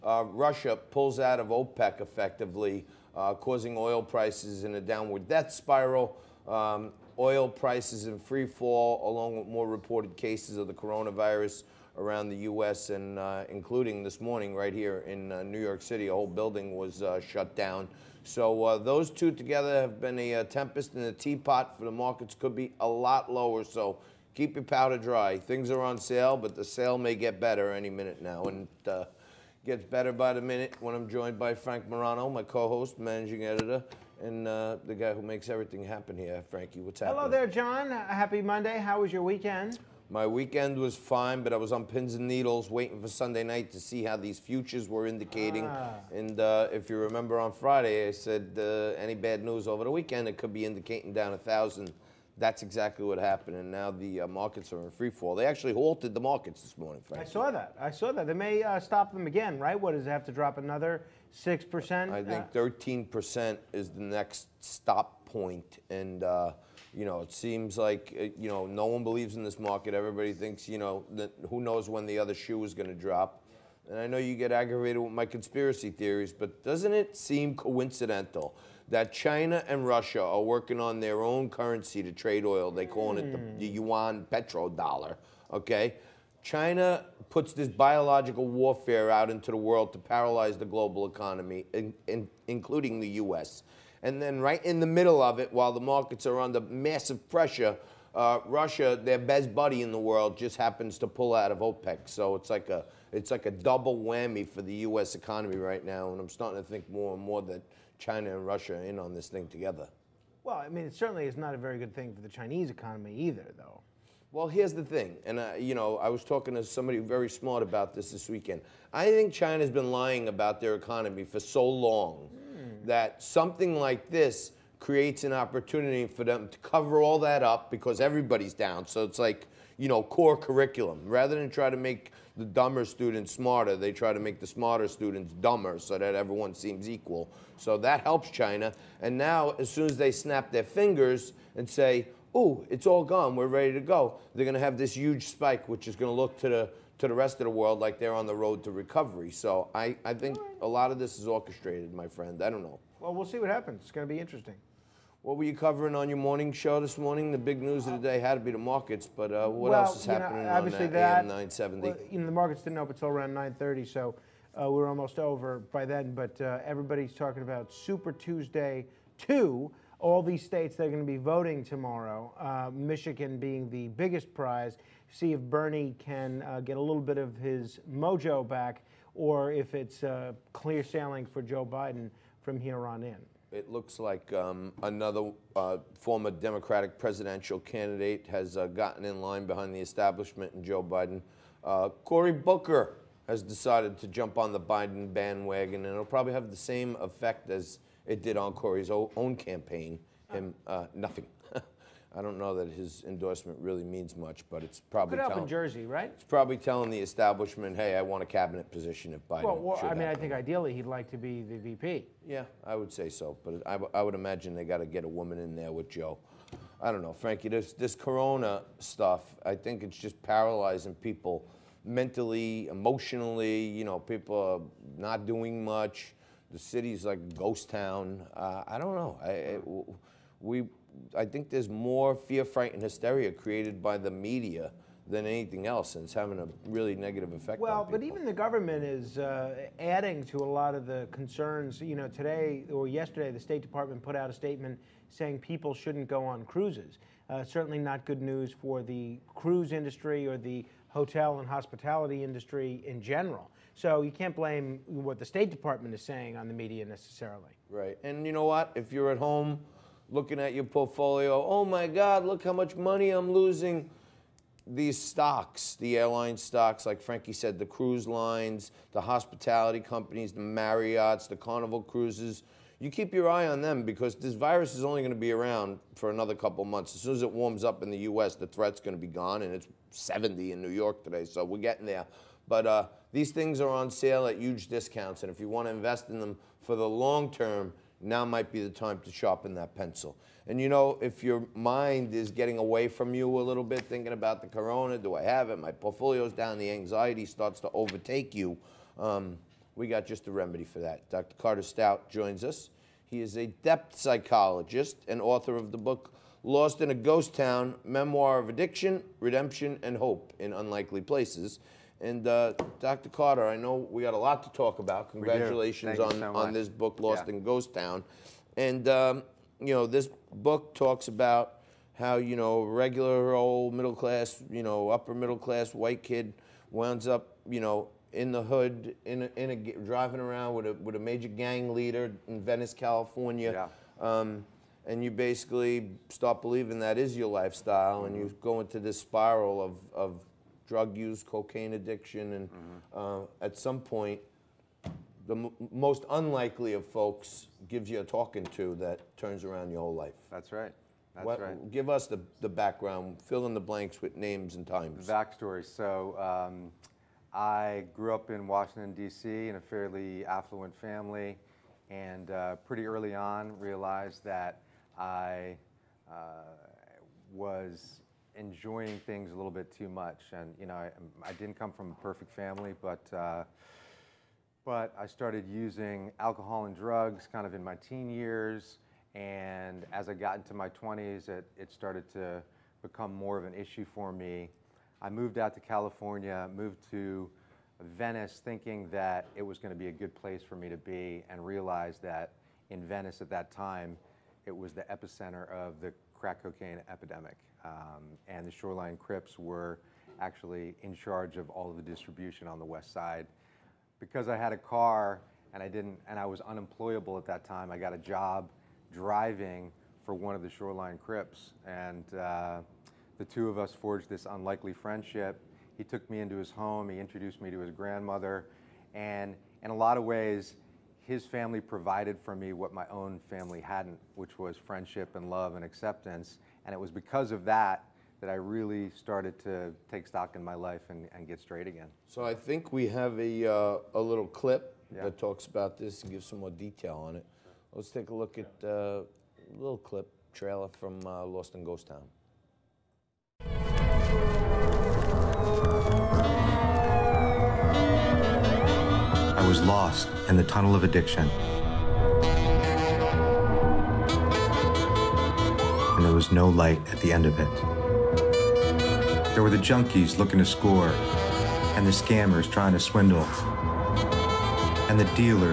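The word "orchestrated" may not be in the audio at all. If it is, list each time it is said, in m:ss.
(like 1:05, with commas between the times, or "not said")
2:31.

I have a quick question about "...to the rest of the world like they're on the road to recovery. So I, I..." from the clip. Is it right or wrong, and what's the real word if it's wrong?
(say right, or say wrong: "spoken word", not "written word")
right.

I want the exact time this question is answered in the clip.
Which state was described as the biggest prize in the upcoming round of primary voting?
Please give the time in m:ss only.
2:52.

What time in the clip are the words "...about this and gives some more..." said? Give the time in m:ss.
7:15.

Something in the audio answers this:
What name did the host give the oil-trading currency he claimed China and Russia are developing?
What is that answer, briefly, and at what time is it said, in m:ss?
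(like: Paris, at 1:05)
yuan petrodollar, at 1:23.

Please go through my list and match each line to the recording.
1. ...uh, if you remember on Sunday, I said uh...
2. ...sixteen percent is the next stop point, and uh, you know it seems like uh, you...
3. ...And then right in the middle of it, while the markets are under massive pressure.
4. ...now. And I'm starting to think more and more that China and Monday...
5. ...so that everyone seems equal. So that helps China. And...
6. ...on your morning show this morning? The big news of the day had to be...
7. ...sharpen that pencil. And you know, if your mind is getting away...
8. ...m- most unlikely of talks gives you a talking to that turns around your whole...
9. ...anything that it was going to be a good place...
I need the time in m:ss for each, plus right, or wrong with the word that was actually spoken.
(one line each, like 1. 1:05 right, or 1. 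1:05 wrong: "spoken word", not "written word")
1. 0:46 wrong: "Friday", not "Sunday"
2. 1:02 wrong: "thirteen", not "sixteen"
3. 1:34 right
4. 1:45 wrong: "Russia", not "Monday"
5. 2:15 right
6. 2:35 right
7. 4:49 right
8. 5:45 wrong: "folks", not "talks"
9. 6:28 wrong: "thinking", not "anything".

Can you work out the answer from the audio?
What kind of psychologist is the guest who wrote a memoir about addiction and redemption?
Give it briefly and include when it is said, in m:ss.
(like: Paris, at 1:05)
depth psychologist, at 5:03.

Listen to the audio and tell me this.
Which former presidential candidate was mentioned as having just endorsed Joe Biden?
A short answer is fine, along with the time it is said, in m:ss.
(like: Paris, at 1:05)
Cory Booker, at 3:12.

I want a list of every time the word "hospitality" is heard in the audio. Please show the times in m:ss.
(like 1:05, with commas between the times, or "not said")
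4:11, 4:29.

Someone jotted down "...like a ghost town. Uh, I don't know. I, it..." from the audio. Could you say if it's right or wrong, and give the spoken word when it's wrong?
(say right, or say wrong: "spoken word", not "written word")
right.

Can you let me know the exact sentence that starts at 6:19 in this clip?
And as I got into my 20s, it, it started to become more of an issue for me.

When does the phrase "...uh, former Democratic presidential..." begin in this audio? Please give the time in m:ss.
3:05.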